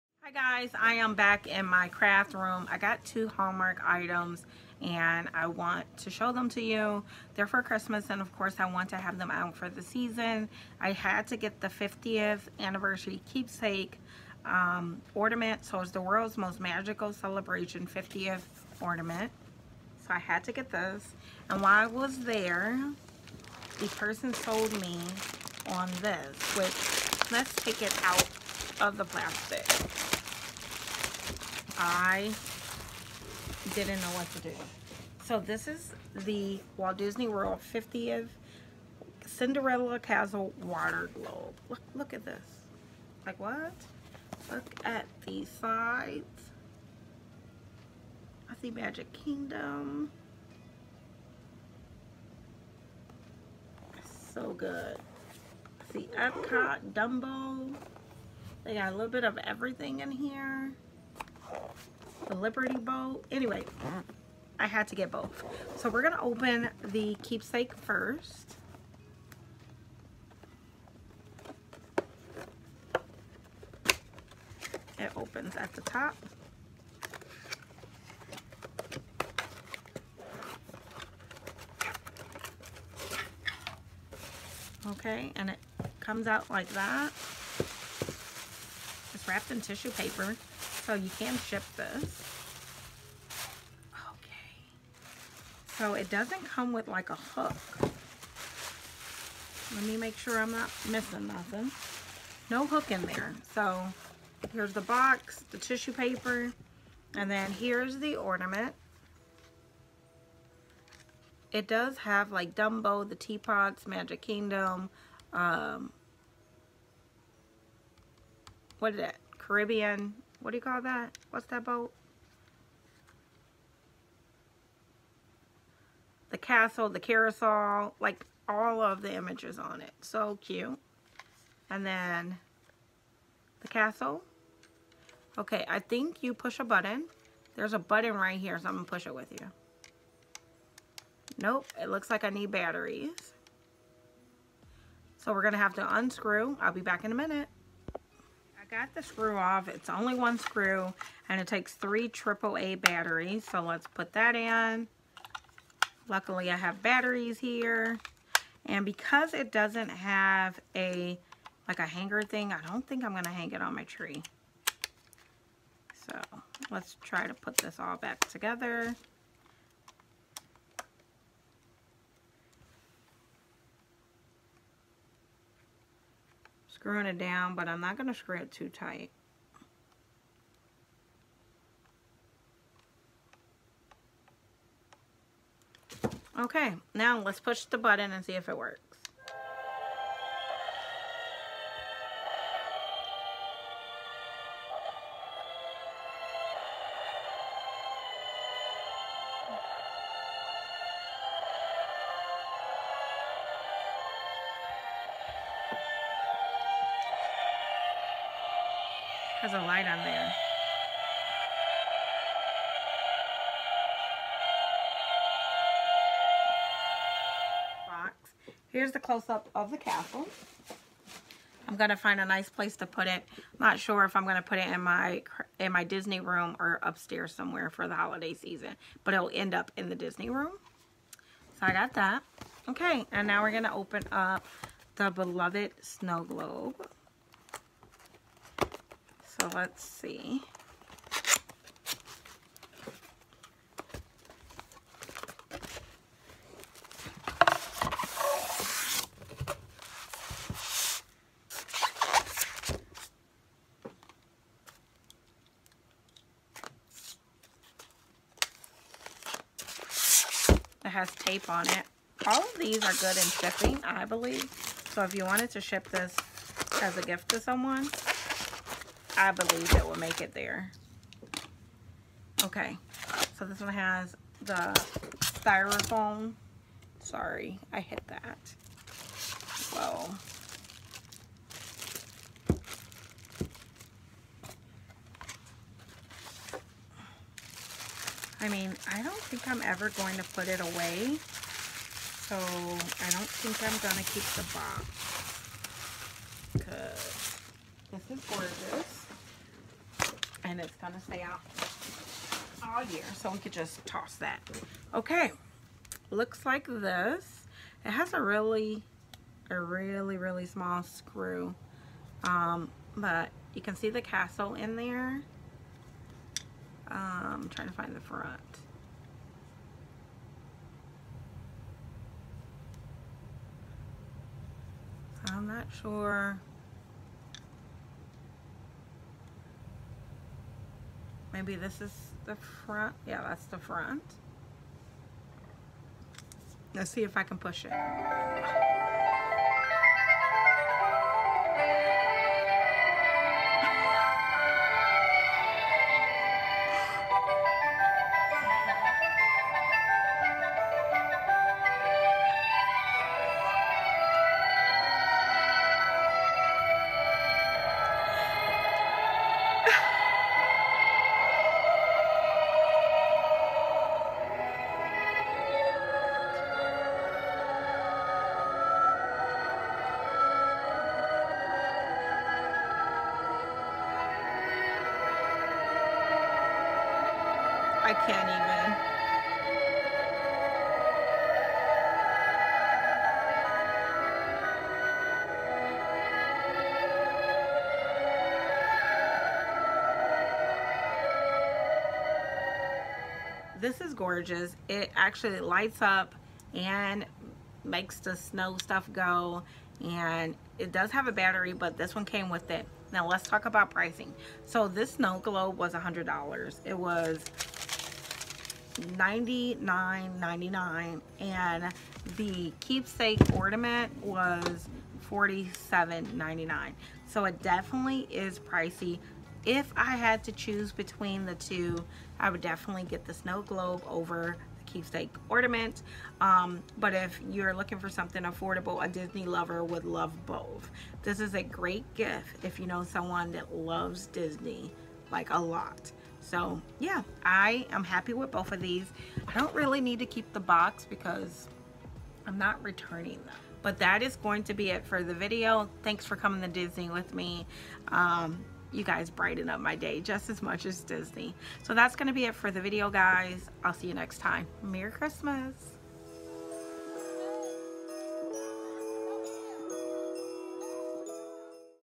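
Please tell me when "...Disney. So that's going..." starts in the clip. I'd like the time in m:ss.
7:30.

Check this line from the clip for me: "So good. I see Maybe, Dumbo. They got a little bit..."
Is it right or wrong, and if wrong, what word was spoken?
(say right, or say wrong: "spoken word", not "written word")
wrong: "Epcot", not "Maybe".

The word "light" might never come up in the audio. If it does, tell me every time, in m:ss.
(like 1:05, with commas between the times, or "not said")
3:29, 6:35.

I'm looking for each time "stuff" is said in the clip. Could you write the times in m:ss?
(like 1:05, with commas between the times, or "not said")
6:38.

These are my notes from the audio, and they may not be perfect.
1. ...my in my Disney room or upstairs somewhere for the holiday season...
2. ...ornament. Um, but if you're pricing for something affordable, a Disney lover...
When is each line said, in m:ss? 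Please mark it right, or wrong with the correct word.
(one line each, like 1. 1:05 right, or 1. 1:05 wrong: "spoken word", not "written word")
1. 3:44 right
2. 7:05 wrong: "looking", not "pricing".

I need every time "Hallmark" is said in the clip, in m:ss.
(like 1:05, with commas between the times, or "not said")
0:03.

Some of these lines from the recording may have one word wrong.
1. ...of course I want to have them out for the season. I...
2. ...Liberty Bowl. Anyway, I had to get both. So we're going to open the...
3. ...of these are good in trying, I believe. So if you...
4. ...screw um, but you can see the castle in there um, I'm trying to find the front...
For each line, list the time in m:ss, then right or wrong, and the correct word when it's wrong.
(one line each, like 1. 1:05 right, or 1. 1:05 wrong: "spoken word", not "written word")
1. 0:08 right
2. 1:02 right
3. 4:22 wrong: "shipping", not "trying"
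4. 5:10 right.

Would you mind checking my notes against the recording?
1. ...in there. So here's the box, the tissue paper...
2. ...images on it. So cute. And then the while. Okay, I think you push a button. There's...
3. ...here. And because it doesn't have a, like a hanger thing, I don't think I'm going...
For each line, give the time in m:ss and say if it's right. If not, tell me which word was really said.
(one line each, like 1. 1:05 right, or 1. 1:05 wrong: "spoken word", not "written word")
1. 1:42 right
2. 2:09 wrong: "castle", not "while"
3. 2:37 right.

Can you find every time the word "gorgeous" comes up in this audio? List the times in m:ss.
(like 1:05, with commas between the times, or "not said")
4:58, 6:33.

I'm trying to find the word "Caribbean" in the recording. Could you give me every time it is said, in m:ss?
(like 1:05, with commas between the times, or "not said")
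1:59.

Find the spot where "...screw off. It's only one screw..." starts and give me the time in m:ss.
2:29.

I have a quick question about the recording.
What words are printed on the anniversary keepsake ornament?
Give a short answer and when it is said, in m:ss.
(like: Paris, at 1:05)
World's most magical celebration, at 0:16.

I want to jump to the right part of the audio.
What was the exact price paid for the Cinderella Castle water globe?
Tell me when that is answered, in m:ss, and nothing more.
6:48.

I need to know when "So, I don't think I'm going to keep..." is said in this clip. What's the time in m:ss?
4:52.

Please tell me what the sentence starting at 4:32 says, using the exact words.
Okay, so this one has the styrofoam.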